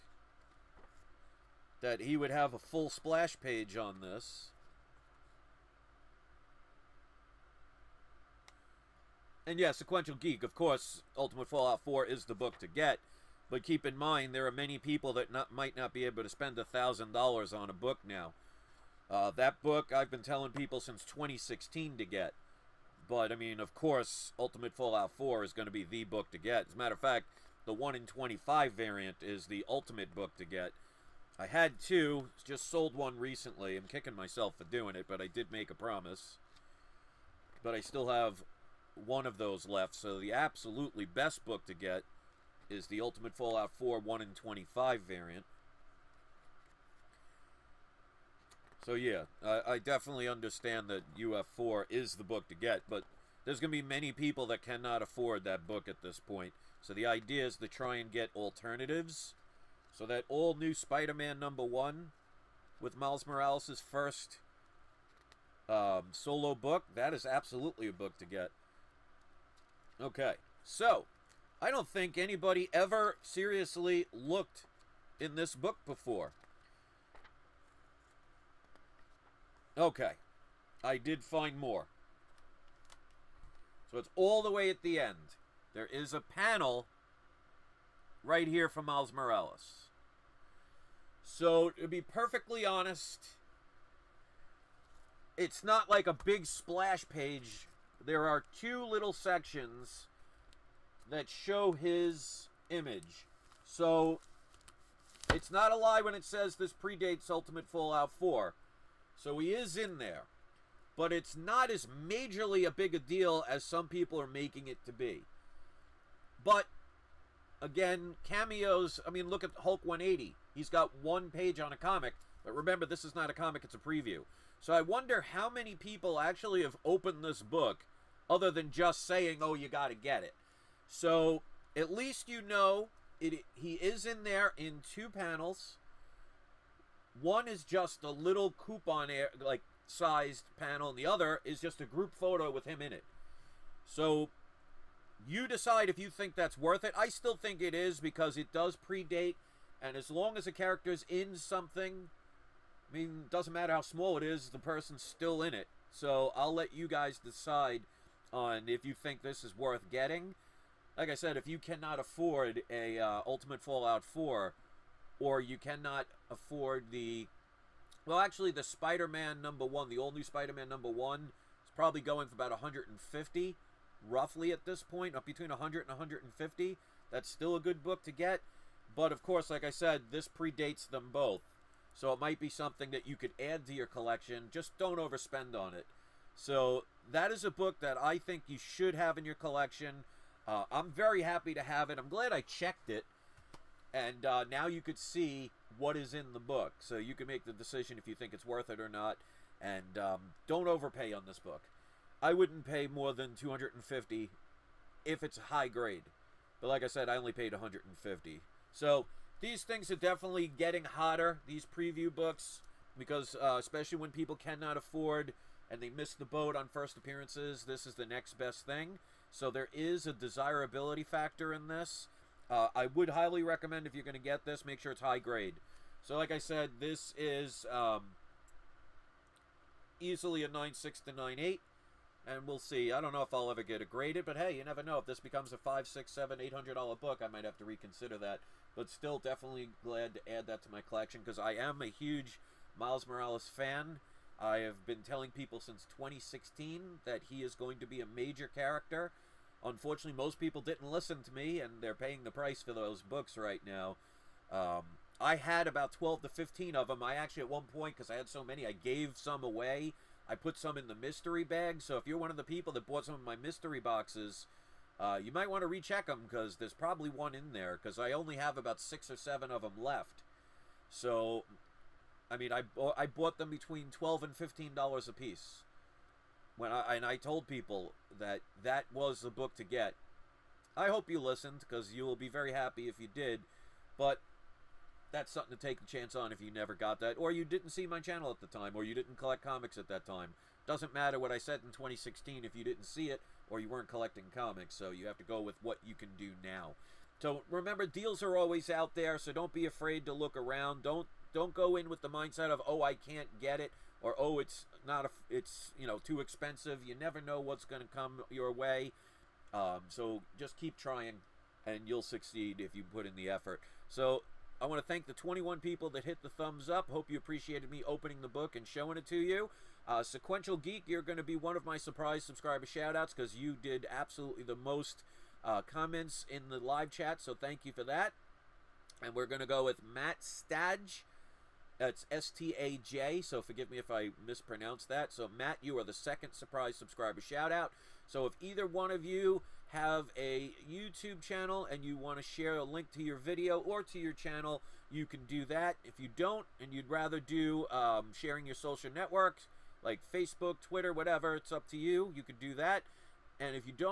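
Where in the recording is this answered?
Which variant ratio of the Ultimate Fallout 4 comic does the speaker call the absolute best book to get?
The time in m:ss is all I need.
0:27.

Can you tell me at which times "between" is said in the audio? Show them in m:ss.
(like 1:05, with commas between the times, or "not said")
2:55, 4:33.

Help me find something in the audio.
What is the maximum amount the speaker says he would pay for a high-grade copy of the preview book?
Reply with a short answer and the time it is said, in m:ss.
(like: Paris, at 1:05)
250, at 3:22.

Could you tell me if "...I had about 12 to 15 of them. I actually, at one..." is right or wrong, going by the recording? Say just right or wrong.
right.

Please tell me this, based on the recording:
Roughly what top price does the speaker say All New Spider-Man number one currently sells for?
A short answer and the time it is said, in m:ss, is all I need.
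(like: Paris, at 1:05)
150, at 2:55.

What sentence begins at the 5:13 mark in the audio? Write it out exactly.
So I want to thank the 21 people that hit the thumbs up.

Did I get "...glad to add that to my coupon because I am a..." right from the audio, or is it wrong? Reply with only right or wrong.
wrong.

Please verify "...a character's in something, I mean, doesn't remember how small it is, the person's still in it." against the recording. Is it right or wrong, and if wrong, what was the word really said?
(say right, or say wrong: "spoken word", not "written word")
wrong: "matter", not "remember".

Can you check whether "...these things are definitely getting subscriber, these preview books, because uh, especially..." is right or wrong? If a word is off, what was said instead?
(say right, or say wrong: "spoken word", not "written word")
wrong: "hotter", not "subscriber".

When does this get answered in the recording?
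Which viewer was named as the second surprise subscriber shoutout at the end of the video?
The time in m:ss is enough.
5:29.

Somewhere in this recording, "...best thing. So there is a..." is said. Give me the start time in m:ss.
3:38.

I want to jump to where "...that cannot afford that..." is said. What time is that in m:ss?
0:54.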